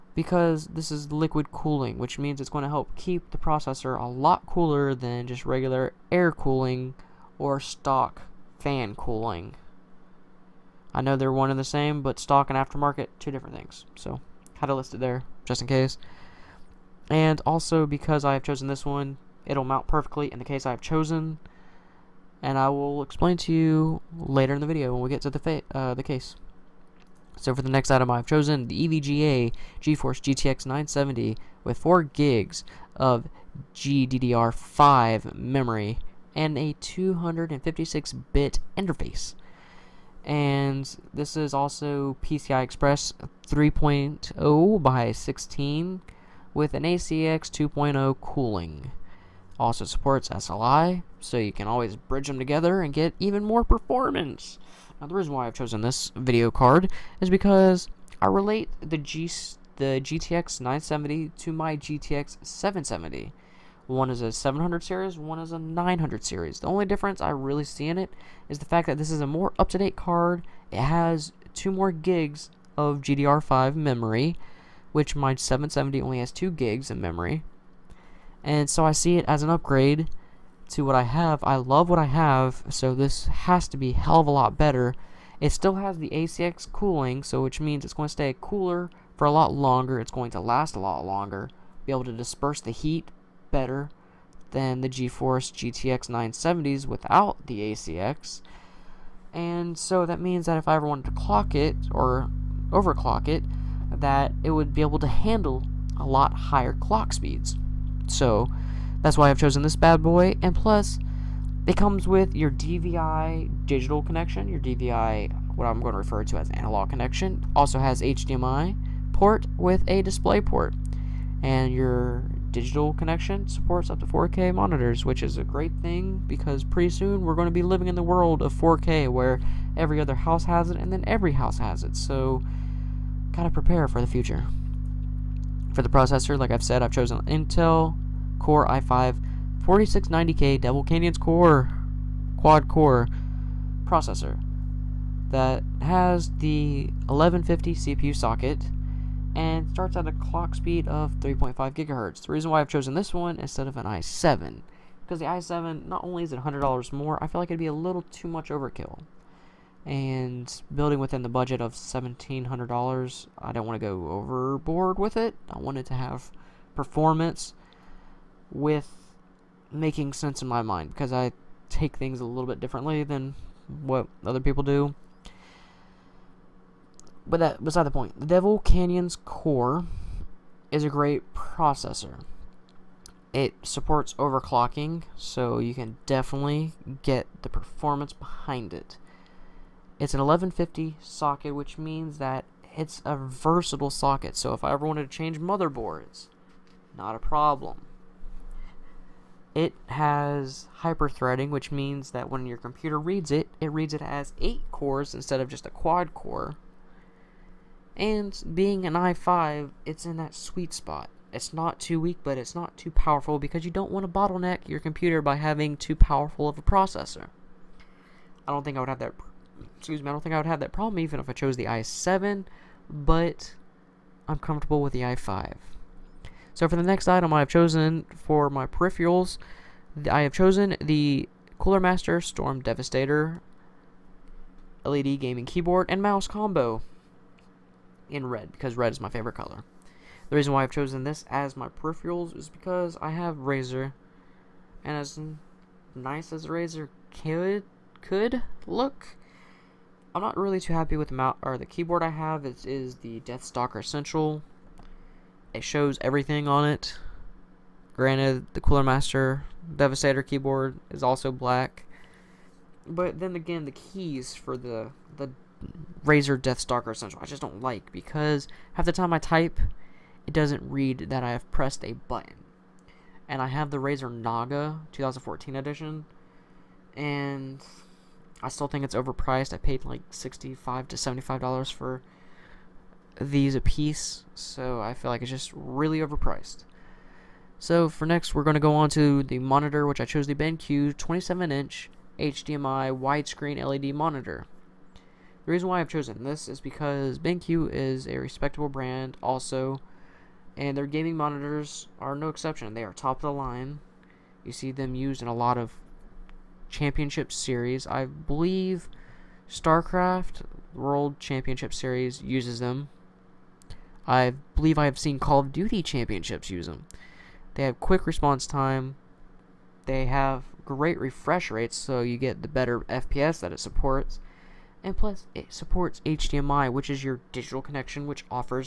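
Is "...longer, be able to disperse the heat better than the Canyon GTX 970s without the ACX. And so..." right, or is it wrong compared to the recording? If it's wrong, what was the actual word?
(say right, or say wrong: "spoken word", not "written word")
wrong: "GeForce", not "Canyon".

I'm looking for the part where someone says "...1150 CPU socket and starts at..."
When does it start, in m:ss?
2:27.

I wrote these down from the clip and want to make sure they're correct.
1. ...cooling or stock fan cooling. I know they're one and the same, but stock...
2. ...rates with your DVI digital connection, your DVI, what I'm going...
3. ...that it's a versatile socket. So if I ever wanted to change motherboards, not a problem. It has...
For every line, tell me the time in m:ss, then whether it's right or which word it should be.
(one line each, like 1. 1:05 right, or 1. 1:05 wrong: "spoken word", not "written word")
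1. 0:06 right
2. 1:51 wrong: "comes", not "rates"
3. 3:12 right.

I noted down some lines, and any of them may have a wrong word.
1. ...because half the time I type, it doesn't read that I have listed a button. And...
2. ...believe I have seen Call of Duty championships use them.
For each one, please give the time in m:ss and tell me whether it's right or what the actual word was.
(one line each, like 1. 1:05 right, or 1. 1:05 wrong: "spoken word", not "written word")
1. 4:27 wrong: "pressed", not "listed"
2. 5:14 right.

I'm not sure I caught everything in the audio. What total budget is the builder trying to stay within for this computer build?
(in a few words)
$1,700.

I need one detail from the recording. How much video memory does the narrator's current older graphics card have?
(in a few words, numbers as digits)
2 gigs.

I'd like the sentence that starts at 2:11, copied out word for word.
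So, gotta prepare for the future.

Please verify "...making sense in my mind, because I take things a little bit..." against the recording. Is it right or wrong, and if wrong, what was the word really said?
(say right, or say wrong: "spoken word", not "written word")
right.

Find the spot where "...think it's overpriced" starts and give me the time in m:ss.
4:38.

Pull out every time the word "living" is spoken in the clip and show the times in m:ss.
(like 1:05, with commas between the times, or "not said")
2:07.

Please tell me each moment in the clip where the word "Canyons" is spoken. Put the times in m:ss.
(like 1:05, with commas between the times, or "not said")
2:20, 2:58.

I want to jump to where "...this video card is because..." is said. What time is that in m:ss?
0:55.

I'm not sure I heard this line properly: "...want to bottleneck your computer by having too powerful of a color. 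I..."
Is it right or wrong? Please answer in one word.
wrong.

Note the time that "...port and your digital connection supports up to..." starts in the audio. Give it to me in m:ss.
2:00.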